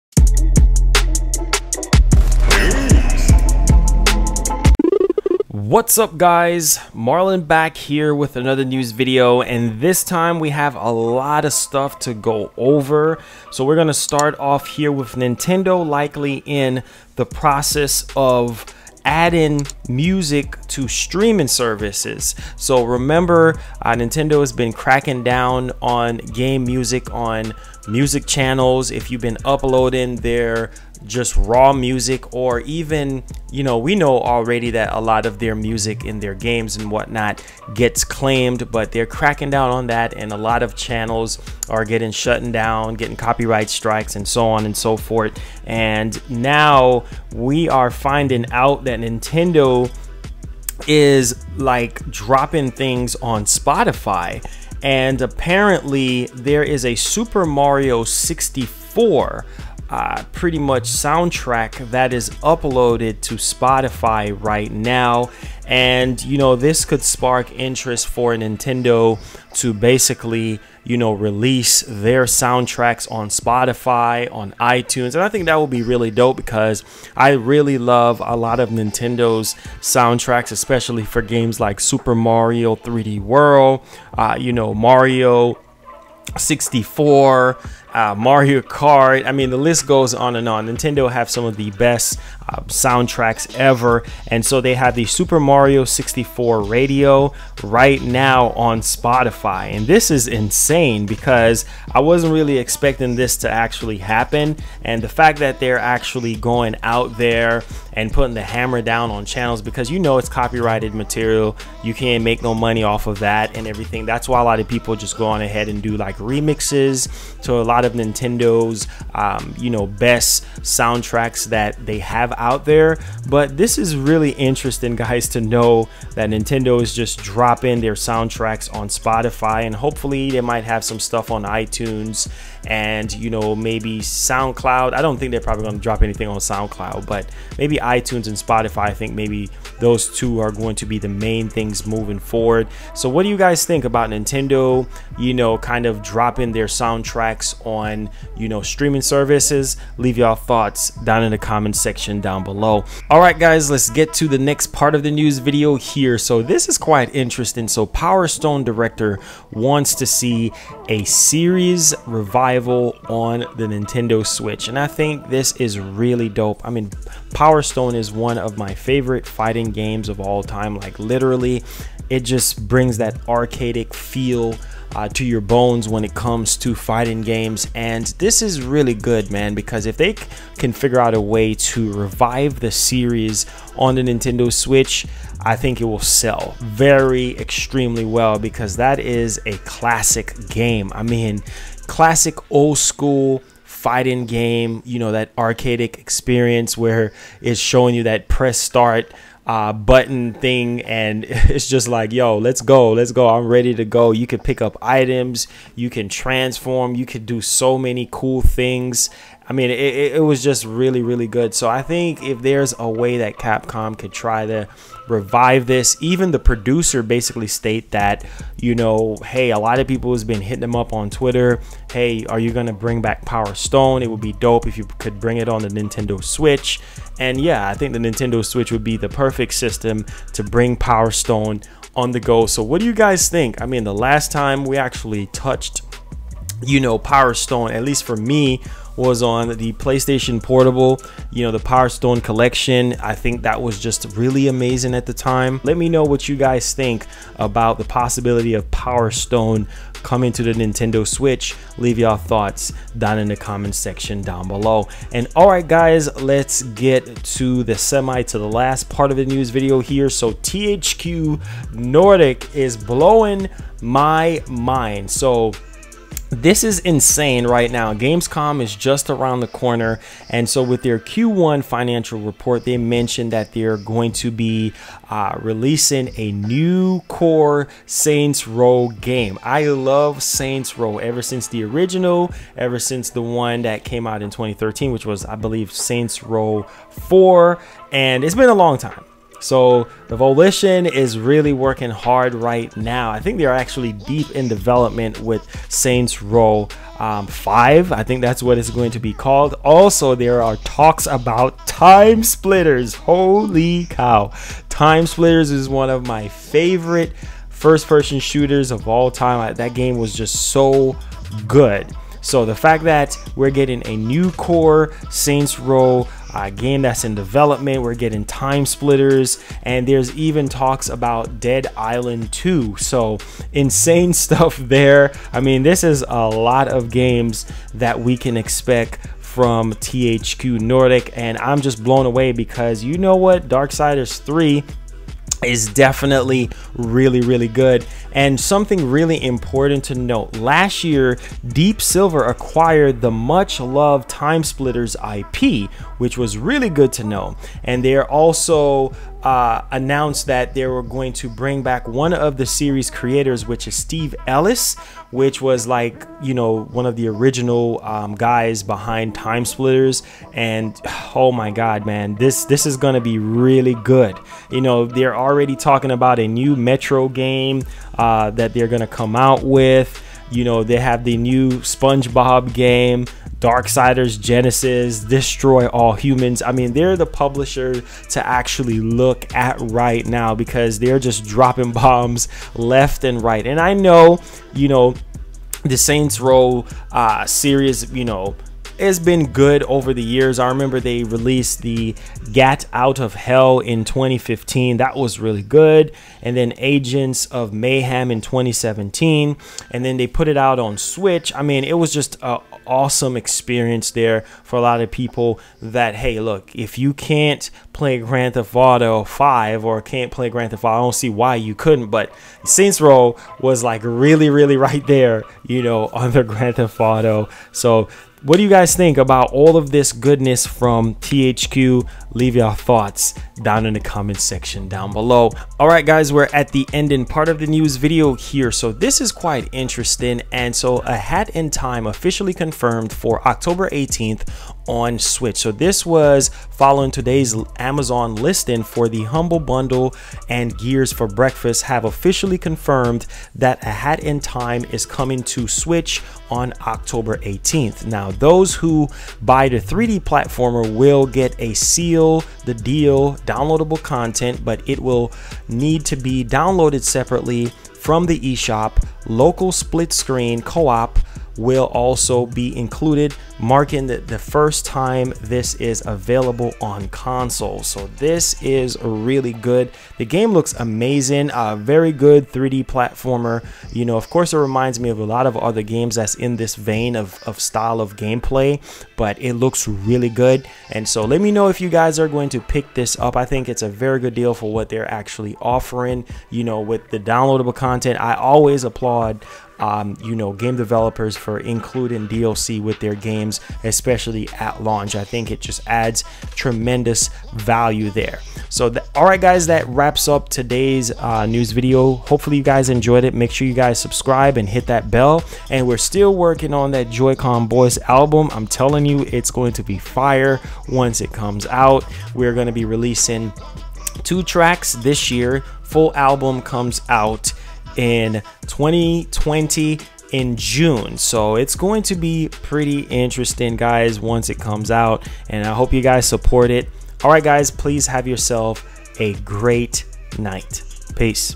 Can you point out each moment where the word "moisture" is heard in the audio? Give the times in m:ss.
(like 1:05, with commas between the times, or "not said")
not said.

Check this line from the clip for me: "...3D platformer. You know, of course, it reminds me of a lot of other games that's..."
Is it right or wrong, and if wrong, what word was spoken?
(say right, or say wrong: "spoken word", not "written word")
right.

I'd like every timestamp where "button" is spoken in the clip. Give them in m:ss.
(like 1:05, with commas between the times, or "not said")
3:19.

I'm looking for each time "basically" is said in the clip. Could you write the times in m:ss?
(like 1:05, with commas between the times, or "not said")
1:09, 3:37.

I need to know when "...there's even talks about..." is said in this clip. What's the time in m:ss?
5:19.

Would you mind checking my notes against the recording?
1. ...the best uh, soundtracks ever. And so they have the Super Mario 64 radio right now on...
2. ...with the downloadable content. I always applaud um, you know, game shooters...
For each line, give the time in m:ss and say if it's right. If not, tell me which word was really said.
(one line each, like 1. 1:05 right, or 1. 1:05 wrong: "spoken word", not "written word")
1. 1:31 right
2. 8:06 wrong: "developers", not "shooters".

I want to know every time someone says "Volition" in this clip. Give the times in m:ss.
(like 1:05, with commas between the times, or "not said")
4:50.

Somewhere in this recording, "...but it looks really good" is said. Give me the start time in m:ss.
7:58.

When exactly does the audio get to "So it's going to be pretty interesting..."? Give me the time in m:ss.
8:40.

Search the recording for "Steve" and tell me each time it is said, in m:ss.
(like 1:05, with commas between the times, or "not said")
5:53.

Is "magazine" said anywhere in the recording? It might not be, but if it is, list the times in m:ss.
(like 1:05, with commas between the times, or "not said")
not said.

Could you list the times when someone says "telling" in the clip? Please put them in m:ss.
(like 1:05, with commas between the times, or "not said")
8:28.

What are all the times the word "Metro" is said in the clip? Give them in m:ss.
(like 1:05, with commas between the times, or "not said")
6:06.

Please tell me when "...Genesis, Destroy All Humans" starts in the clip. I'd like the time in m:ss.
6:14.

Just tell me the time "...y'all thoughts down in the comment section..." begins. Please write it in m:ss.
2:30.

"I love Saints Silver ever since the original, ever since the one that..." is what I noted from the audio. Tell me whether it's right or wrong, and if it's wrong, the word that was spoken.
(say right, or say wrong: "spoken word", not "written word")
wrong: "Row", not "Silver".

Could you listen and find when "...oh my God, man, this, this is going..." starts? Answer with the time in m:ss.
6:01.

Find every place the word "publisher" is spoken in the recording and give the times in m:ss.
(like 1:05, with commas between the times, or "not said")
6:17.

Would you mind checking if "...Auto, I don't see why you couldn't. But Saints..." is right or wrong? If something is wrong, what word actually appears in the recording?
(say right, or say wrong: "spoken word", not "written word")
right.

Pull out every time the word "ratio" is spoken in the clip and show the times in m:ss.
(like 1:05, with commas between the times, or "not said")
not said.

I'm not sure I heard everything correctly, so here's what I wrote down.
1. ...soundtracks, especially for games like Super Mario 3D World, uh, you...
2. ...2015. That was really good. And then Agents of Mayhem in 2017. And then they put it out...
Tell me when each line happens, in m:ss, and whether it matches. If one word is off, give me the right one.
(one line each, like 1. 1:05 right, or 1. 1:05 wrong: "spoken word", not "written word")
1. 1:19 right
2. 6:33 right.